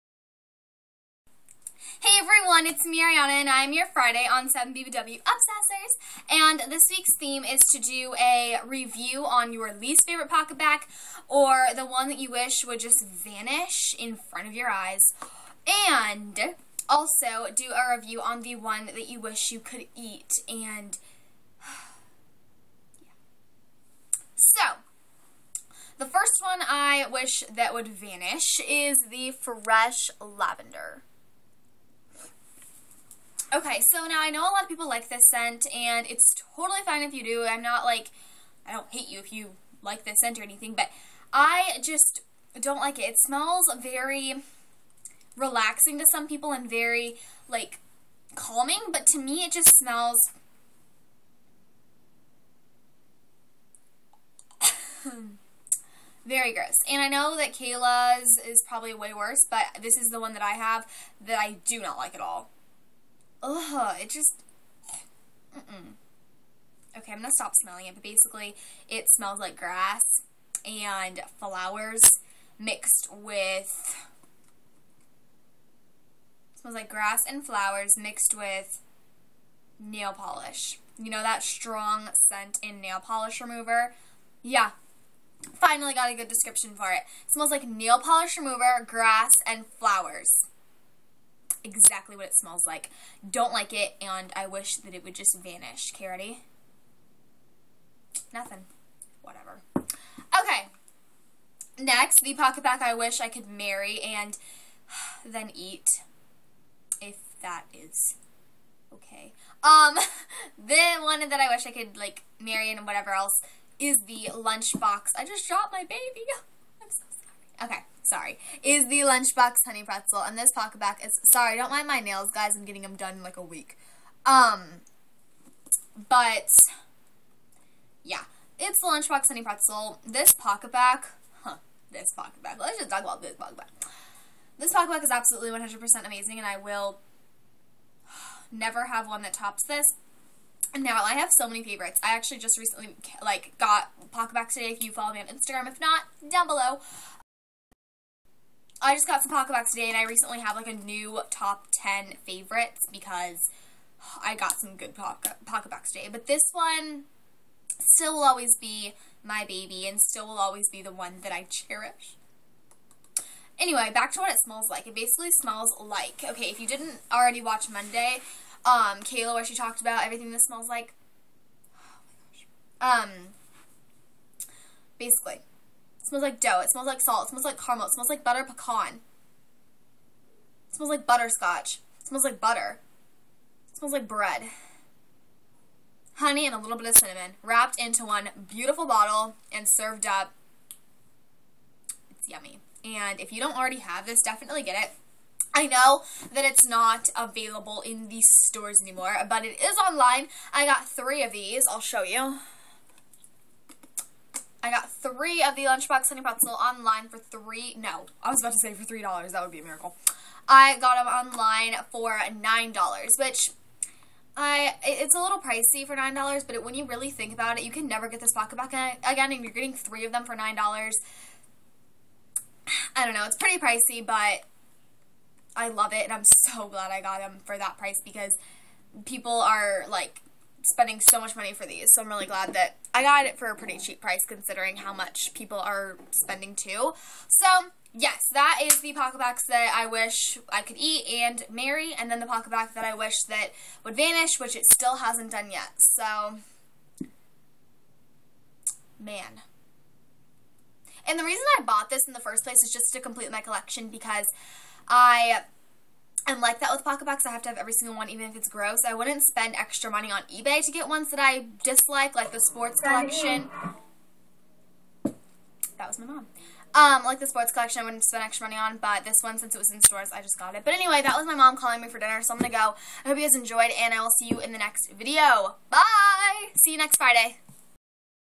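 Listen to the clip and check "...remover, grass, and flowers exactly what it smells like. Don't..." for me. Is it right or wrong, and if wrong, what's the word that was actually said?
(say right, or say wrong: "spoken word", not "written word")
right.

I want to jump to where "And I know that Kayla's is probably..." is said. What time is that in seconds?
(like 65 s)
56 s.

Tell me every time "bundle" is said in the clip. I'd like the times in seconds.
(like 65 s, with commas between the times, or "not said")
not said.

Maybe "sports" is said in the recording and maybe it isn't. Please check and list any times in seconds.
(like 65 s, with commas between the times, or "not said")
262 s, 267 s.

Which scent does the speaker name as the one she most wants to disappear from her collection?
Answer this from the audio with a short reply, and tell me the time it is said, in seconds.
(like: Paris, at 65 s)
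Fresh Lavender, at 29 s.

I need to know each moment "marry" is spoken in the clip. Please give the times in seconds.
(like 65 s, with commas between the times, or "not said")
103 s, 112 s, 241 s.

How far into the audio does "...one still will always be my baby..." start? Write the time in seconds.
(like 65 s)
156 s.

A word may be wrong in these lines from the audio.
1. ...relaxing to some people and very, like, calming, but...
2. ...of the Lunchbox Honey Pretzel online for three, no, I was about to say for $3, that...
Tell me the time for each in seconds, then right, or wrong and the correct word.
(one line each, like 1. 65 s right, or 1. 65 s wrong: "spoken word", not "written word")
1. 45 s right
2. 205 s right.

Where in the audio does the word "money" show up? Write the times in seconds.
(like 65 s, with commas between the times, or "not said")
231 s, 259 s, 268 s.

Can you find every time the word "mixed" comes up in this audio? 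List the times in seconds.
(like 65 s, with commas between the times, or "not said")
72 s, 77 s.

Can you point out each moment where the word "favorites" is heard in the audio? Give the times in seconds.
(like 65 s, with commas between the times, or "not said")
10 s, 141 s, 152 s.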